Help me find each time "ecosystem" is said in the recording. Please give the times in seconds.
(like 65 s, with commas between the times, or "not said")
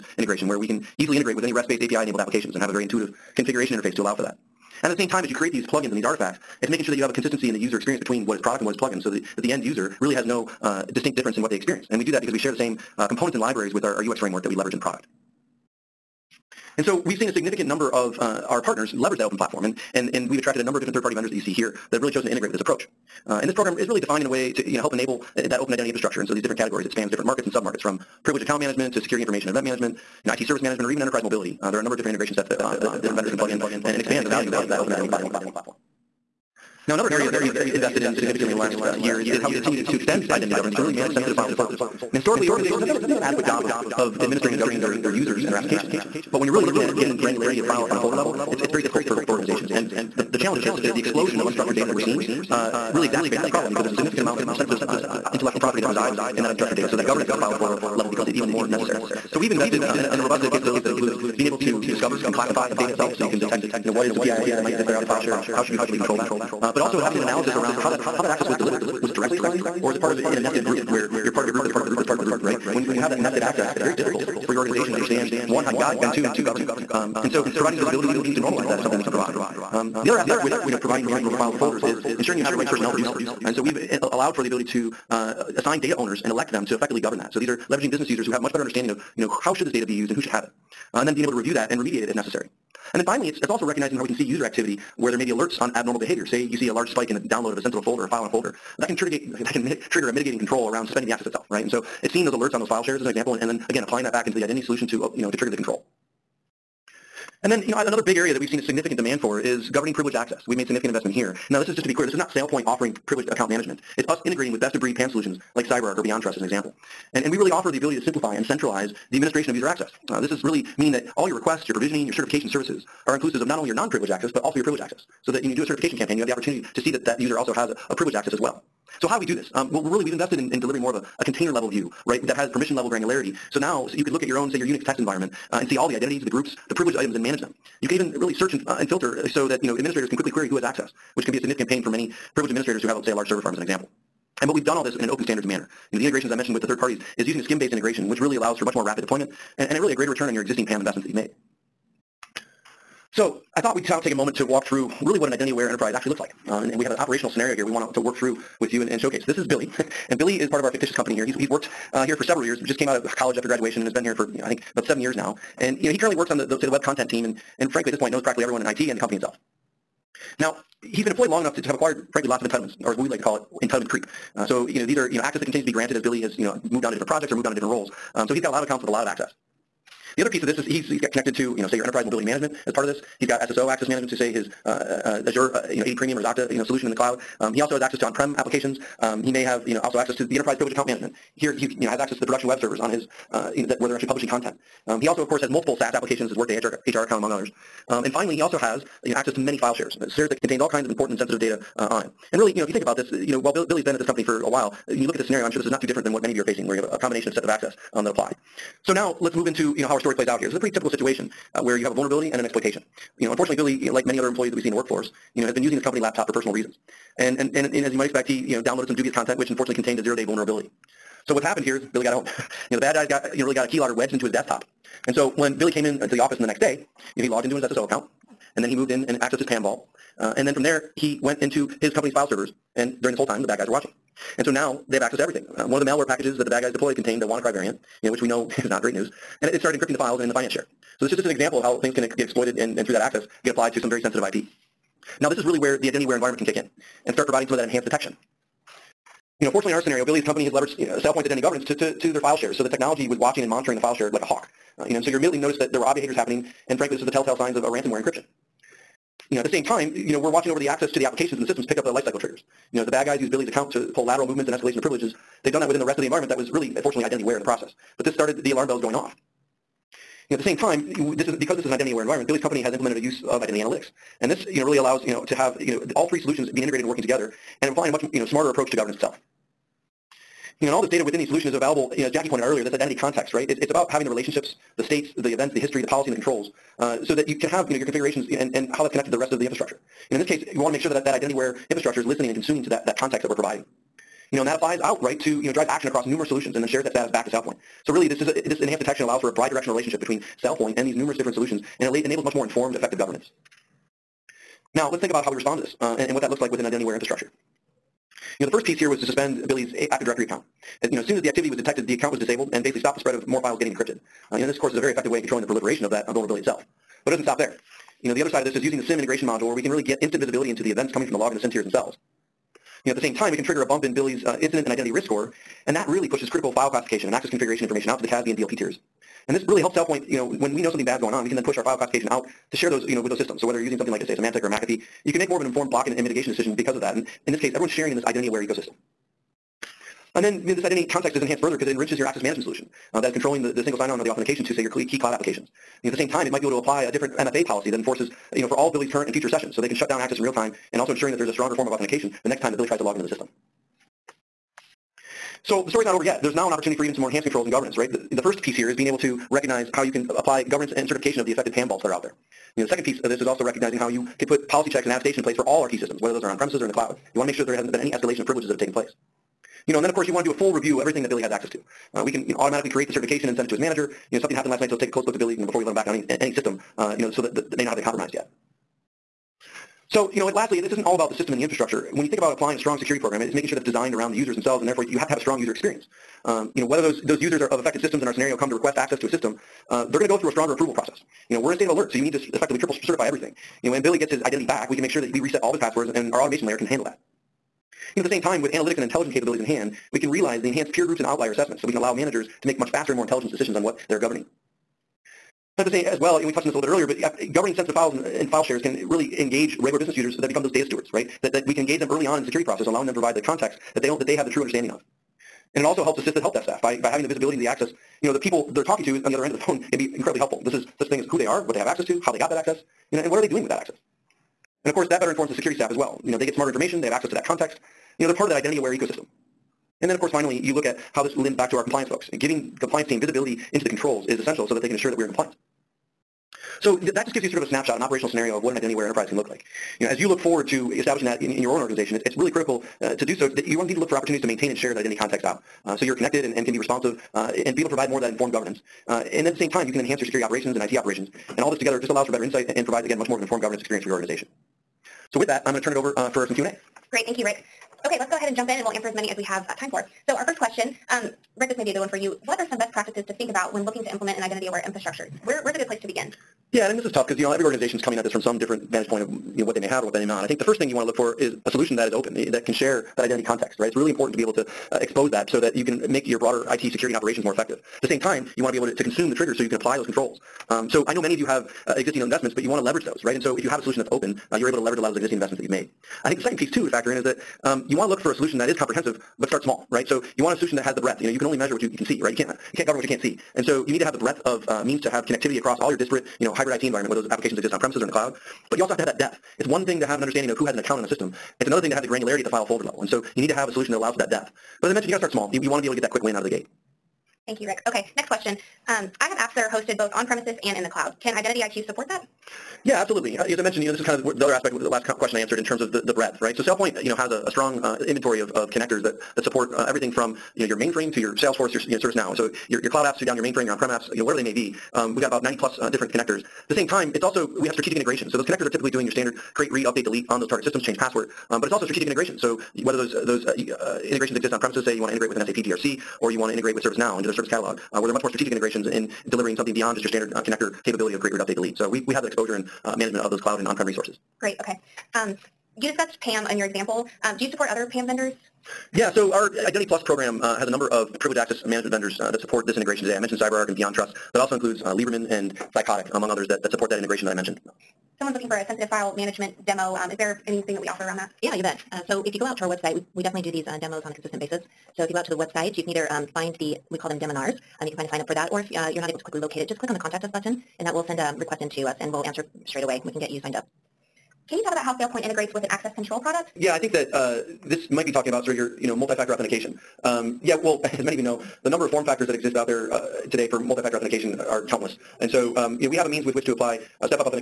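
338 s, 428 s.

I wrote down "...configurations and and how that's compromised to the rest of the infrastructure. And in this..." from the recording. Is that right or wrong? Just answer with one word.
wrong.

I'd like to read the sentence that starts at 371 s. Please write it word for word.
Uh, we can you know, automatically create the certification and send it to his manager.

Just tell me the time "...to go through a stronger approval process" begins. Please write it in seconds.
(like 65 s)
390 s.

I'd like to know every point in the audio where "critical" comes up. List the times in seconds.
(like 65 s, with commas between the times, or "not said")
326 s, 442 s.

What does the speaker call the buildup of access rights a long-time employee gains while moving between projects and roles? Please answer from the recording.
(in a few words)
entitlement creep.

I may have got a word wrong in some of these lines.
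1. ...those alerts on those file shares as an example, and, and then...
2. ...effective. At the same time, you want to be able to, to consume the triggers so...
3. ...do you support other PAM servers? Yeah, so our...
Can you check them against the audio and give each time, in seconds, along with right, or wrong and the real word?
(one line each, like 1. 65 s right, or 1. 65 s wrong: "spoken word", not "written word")
1. 102 s right
2. 477 s right
3. 547 s wrong: "vendors", not "servers".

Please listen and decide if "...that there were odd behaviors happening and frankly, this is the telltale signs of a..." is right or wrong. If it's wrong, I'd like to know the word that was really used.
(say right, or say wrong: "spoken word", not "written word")
right.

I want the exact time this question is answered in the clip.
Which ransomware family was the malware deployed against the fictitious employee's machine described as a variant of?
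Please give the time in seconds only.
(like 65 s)
237 s.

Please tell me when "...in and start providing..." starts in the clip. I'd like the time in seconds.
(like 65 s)
246 s.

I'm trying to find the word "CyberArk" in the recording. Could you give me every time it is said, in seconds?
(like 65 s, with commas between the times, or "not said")
115 s, 553 s.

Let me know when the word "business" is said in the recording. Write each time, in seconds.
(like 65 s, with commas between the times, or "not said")
87 s, 409 s.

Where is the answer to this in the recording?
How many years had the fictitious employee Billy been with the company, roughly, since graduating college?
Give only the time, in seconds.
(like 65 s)
164 s.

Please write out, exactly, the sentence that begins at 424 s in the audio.
And of course, that better informs the security staff as well.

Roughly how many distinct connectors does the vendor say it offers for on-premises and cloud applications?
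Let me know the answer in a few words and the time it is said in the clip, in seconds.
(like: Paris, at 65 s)
90 plus, at 525 s.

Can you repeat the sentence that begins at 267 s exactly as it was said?
But this started the alarm bells going off.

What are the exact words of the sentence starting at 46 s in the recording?
But when you're really looking at getting granularity of file and a folder level, it's, it's very difficult for, for organizations.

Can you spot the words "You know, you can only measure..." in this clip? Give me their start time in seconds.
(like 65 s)
491 s.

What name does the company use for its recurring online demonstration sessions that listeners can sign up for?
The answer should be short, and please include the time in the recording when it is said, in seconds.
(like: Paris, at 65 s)
Deminars, at 566 s.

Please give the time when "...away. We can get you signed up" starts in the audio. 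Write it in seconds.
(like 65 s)
572 s.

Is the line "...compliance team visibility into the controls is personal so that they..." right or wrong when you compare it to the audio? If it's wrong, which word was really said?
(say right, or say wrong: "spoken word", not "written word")
wrong: "essential", not "personal".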